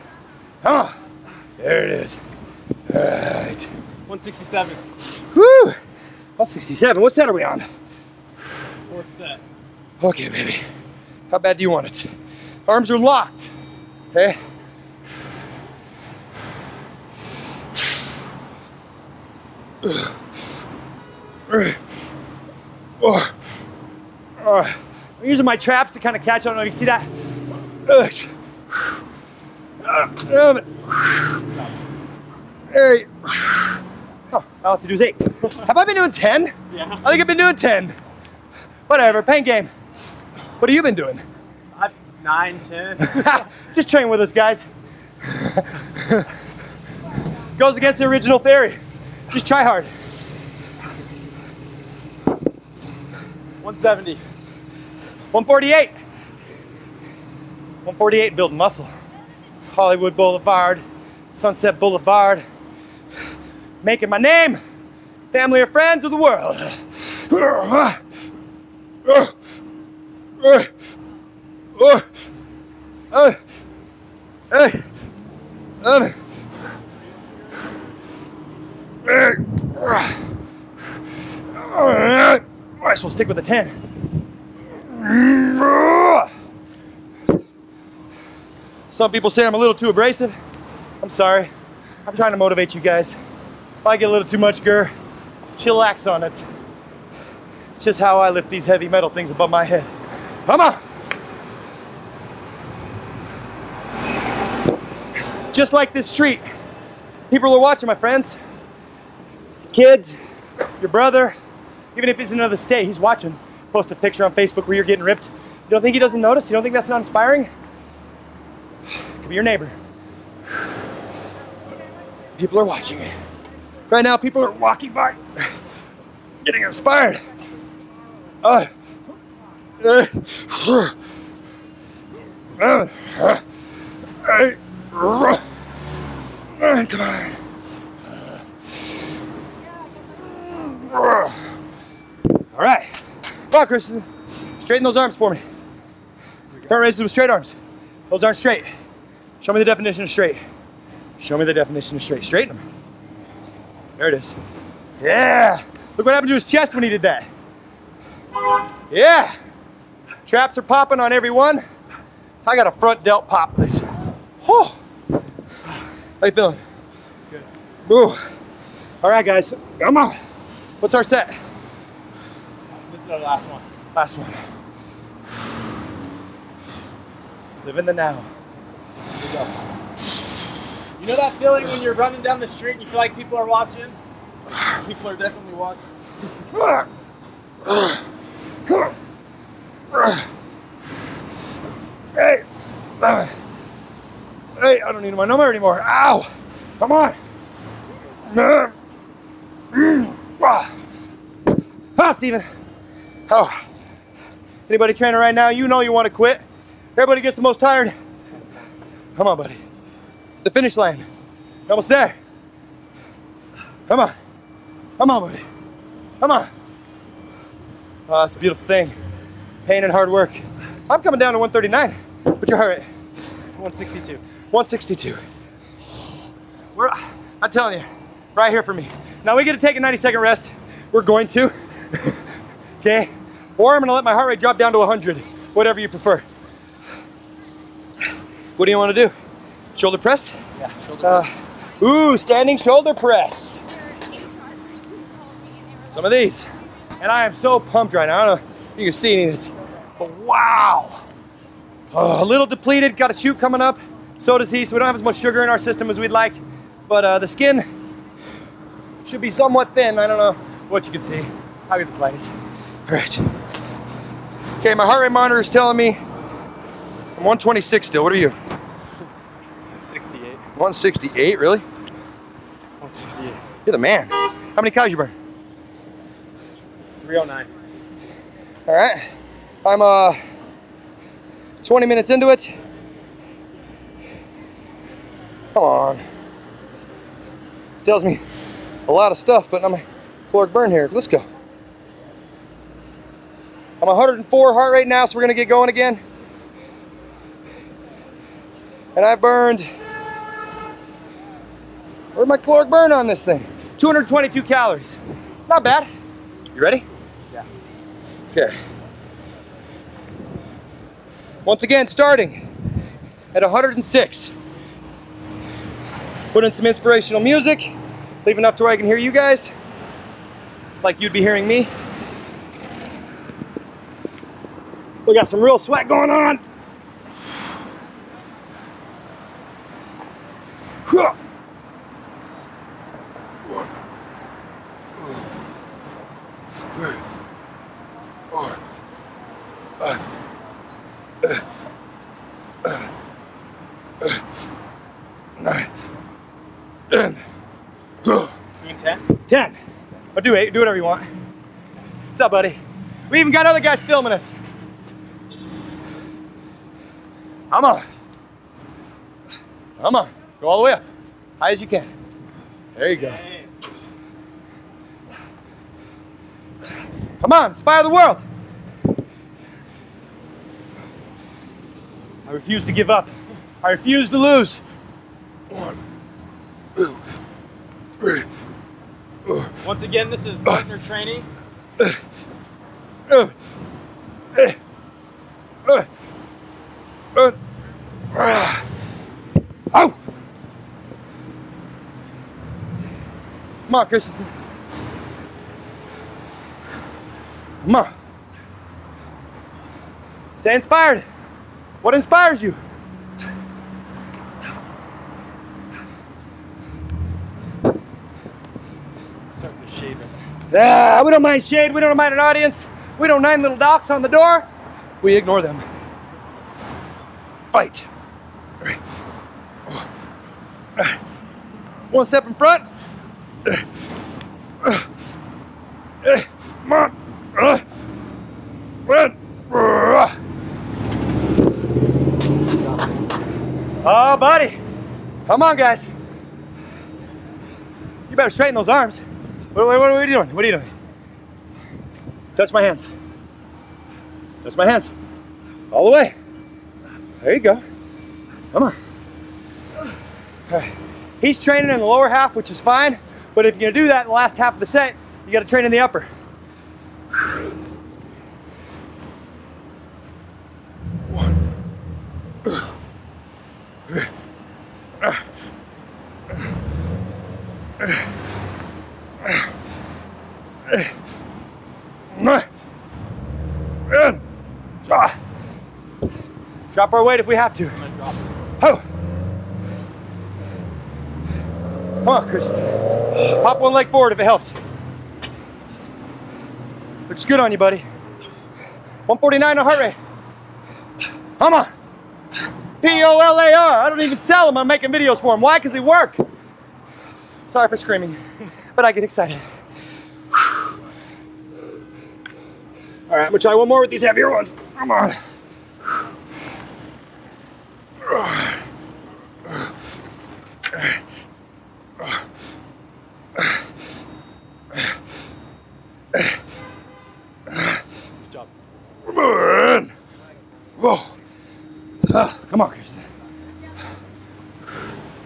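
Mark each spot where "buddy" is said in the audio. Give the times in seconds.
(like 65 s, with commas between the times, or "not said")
209 s, 215 s, 352 s, 434 s, 487 s.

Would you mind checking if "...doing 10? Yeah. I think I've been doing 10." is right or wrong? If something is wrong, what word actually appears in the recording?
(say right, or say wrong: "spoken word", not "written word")
right.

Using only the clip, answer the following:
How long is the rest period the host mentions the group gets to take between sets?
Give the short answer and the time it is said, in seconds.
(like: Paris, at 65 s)
90 seconds, at 229 s.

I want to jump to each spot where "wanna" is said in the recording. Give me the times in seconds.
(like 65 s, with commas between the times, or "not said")
238 s.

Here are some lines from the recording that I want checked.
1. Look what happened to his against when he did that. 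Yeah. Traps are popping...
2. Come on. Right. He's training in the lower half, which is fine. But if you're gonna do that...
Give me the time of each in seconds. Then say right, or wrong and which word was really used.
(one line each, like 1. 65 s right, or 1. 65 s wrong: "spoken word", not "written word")
1. 155 s wrong: "chest", not "against"
2. 448 s right.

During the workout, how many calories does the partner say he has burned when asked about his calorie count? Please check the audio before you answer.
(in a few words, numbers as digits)
309.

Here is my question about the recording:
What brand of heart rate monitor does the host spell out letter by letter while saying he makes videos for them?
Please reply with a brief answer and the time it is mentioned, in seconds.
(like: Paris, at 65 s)
Polar, at 492 s.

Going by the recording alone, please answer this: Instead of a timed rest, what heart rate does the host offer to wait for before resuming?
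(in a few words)
100.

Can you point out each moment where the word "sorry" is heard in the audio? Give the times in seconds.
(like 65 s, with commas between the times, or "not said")
91 s, 497 s.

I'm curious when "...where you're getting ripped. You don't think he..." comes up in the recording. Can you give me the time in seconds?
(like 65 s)
114 s.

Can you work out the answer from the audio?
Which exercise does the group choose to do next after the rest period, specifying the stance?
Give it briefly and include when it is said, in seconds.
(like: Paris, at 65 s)
Standing shoulder press, at 242 s.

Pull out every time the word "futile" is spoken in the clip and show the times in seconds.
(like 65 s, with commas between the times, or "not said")
not said.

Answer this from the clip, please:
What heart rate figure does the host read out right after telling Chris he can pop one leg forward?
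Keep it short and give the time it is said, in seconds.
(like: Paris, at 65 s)
149, at 489 s.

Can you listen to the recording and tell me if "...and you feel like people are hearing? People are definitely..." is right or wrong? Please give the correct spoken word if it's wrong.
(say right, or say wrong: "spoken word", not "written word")
wrong: "watching", not "hearing".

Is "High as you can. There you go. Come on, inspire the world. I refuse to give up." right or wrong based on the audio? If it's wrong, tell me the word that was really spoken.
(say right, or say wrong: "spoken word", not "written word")
right.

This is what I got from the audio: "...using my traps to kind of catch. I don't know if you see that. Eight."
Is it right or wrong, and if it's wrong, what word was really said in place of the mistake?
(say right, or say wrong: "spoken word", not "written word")
right.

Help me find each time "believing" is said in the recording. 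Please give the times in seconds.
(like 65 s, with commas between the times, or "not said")
not said.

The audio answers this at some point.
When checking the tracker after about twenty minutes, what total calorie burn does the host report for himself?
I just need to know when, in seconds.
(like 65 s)
303 s.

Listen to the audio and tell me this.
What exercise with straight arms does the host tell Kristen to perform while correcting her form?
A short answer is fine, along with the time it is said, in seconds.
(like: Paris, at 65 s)
Front raises, at 146 s.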